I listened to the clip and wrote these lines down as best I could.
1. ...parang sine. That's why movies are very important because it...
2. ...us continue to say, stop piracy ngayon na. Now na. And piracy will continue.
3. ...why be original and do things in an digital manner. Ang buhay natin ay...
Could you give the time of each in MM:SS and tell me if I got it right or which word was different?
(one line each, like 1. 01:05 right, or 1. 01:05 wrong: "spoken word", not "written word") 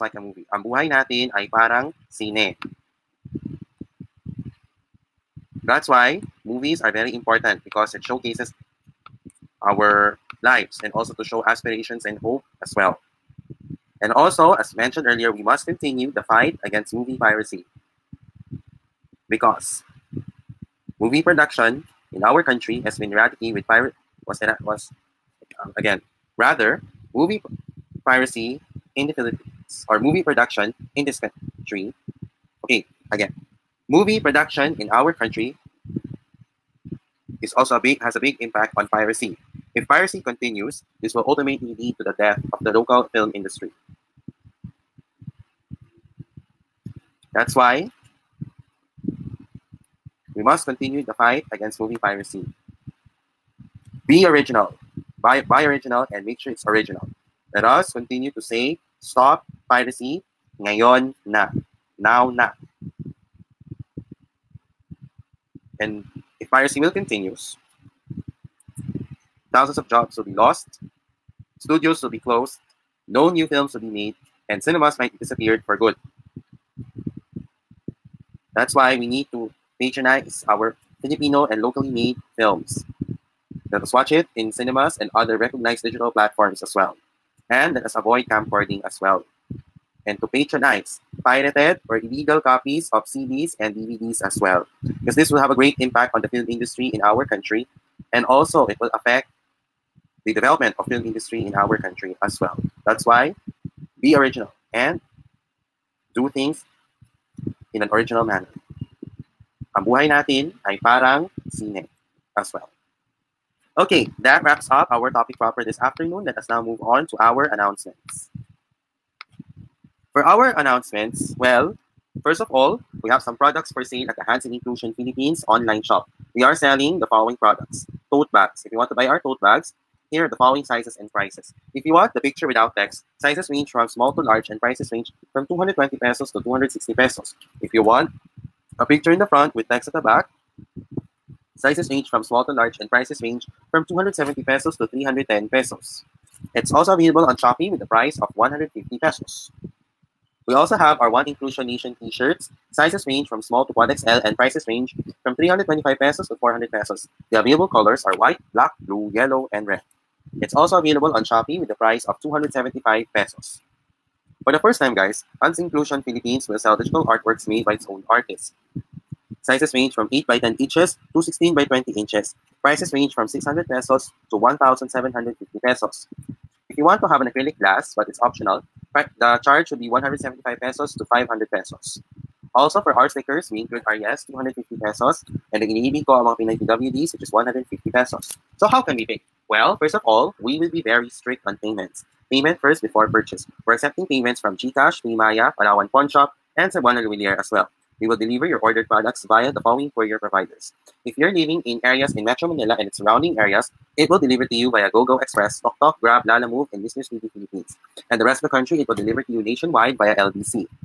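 1. 00:01 right
2. 00:57 right
3. 01:43 wrong: "original", not "digital".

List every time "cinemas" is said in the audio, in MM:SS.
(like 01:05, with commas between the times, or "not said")
01:14, 01:24.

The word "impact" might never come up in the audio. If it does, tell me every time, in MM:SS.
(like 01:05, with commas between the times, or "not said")
00:38, 01:35.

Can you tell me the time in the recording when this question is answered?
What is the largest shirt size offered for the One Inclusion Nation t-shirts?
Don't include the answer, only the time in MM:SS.
02:33.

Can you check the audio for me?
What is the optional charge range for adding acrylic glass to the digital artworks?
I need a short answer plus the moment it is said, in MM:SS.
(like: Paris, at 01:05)
175 to 500 pesos, at 02:59.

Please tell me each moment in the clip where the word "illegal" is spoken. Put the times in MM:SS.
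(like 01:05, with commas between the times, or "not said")
01:32.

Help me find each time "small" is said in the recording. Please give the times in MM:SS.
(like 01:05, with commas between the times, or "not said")
02:13, 02:22, 02:33.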